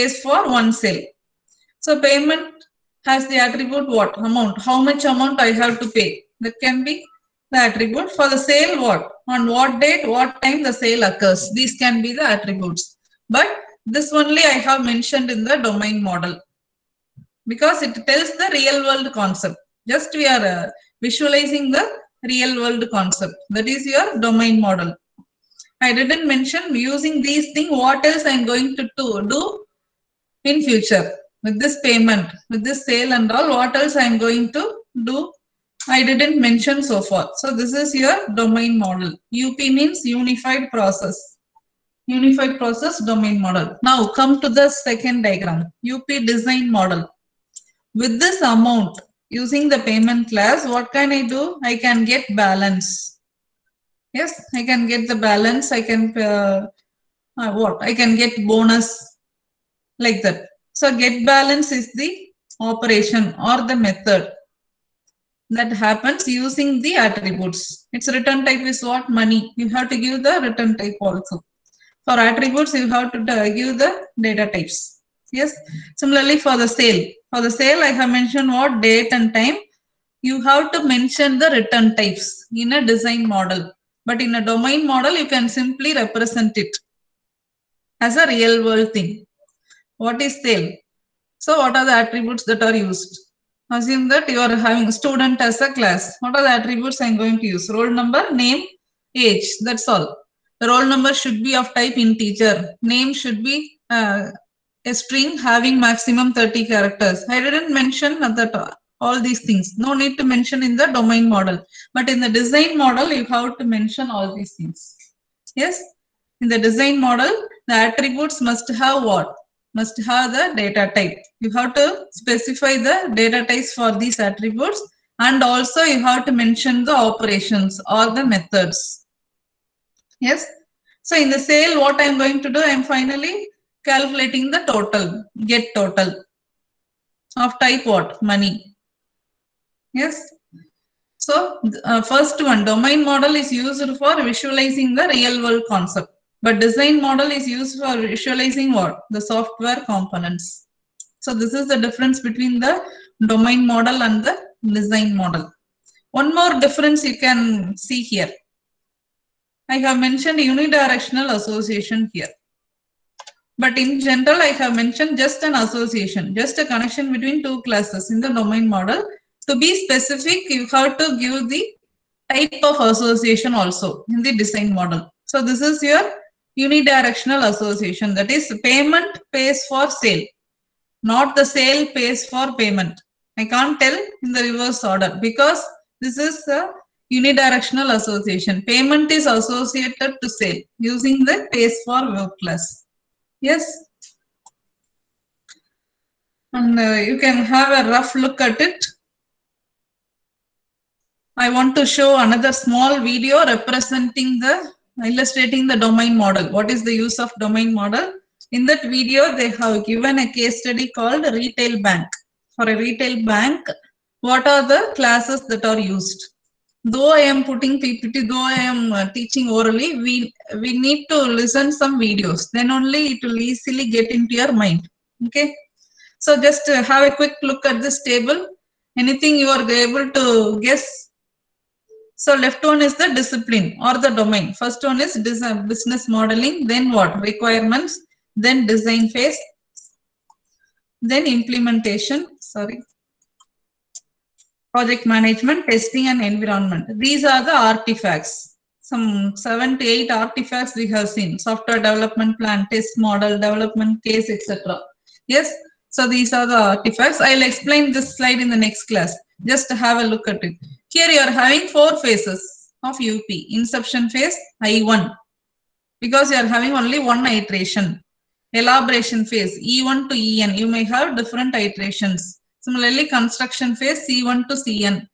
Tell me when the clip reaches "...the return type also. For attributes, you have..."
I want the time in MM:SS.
01:10.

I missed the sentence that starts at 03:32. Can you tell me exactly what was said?
For a retail bank, what are the classes that are used?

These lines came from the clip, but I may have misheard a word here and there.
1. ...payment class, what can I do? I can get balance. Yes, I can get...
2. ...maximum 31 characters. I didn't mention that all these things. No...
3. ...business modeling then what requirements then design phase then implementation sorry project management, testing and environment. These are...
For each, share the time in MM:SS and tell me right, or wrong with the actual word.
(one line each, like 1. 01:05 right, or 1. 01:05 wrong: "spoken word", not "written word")
1. 00:49 right
2. 01:45 wrong: "30", not "31"
3. 03:55 right.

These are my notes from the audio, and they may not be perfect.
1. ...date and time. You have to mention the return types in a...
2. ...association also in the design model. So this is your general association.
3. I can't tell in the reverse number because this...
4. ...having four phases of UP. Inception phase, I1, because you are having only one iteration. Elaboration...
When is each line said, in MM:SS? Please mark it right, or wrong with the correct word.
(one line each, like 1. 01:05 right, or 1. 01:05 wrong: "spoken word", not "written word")
1. 01:18 right
2. 02:52 wrong: "unidirectional", not "general"
3. 03:03 wrong: "order", not "number"
4. 04:21 right.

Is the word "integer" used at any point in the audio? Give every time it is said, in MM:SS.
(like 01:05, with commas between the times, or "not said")
01:41.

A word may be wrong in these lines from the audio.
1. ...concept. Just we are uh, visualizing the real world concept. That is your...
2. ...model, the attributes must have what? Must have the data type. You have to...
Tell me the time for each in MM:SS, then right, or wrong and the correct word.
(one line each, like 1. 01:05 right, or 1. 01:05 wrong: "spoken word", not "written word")
1. 00:19 right
2. 01:57 right.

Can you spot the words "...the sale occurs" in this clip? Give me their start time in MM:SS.
00:10.